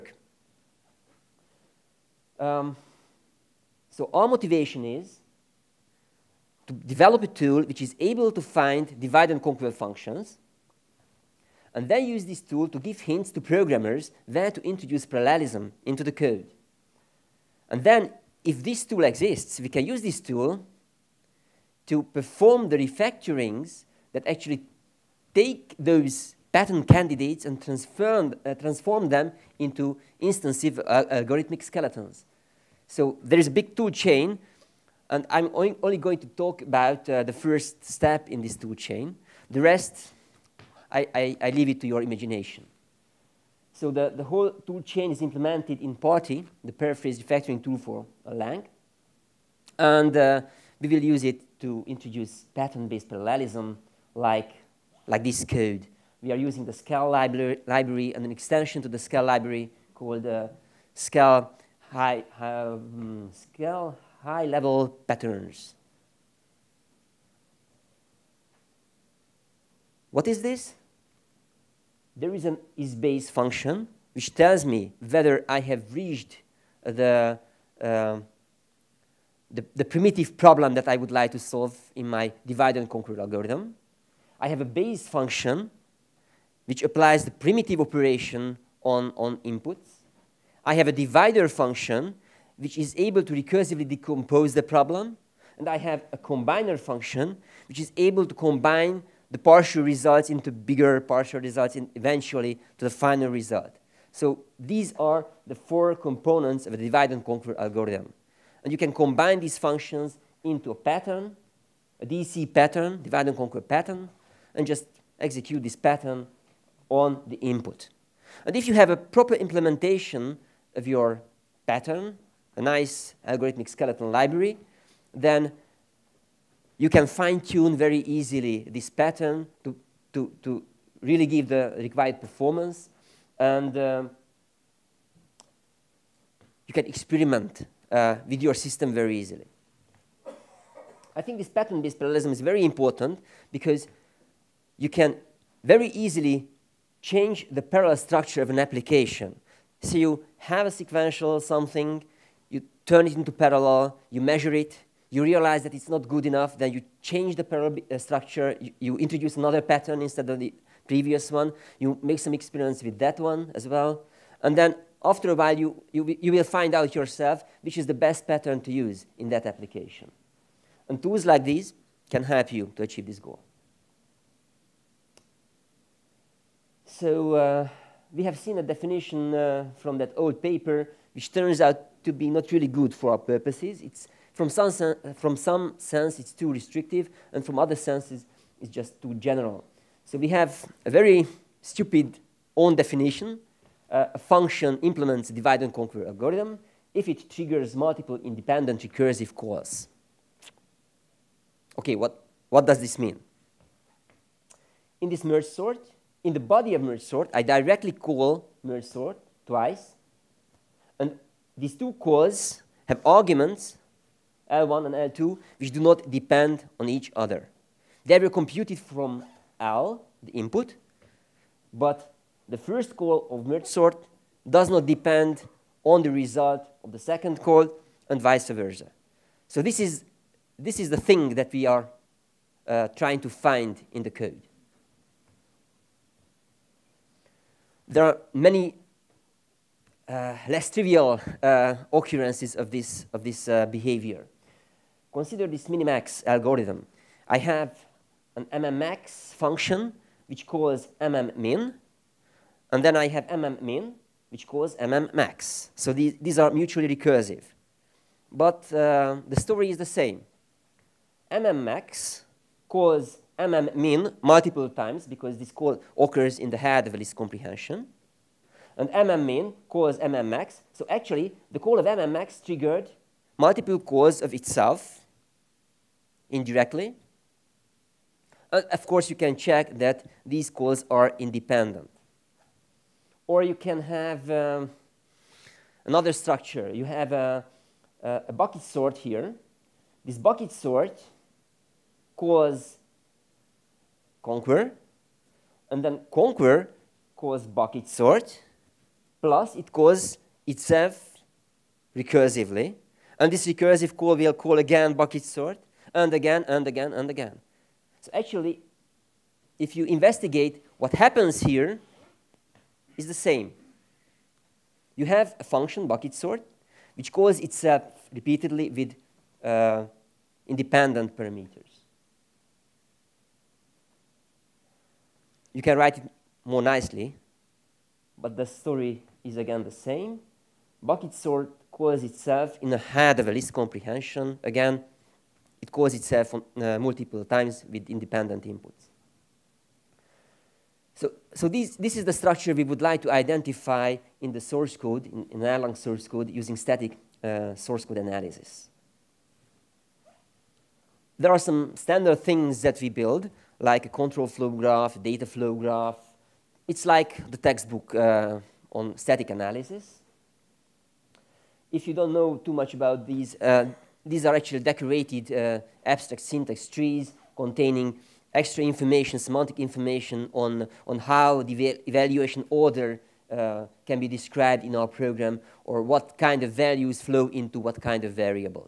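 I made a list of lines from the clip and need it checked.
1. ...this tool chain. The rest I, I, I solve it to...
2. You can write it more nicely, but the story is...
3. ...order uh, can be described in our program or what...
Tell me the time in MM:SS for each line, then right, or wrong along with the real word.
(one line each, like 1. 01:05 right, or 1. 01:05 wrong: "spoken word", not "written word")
1. 00:38 wrong: "leave", not "solve"
2. 05:25 right
3. 06:12 right.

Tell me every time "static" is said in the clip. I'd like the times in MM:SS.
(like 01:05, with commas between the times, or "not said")
05:46, 05:58.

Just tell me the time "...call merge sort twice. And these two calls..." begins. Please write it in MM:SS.
03:27.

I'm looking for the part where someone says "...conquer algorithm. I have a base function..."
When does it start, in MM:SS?
01:22.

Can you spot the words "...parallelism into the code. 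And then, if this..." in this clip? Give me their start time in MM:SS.
00:15.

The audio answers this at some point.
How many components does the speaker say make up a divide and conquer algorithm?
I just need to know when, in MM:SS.
01:45.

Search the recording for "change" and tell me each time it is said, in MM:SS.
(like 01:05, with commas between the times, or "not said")
02:27, 02:37.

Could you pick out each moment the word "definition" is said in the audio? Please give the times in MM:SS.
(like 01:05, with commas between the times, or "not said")
02:58, 03:12.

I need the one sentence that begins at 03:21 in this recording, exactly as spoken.
Okay, what, what does this mean?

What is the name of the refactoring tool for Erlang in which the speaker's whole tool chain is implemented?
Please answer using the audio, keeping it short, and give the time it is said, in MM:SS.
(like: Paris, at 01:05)
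PaRTE, at 00:45.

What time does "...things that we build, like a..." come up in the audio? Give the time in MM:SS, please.
05:52.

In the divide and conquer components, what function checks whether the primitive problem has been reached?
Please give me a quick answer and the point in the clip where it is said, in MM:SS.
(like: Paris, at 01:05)
isBase, at 01:12.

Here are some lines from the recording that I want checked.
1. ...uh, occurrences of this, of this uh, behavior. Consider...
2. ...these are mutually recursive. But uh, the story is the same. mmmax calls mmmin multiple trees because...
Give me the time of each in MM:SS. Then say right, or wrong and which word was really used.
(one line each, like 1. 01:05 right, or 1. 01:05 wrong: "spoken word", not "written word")
1. 04:01 right
2. 04:16 wrong: "times", not "trees".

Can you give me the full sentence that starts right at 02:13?
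And um, you can experiment uh, with your system very easily.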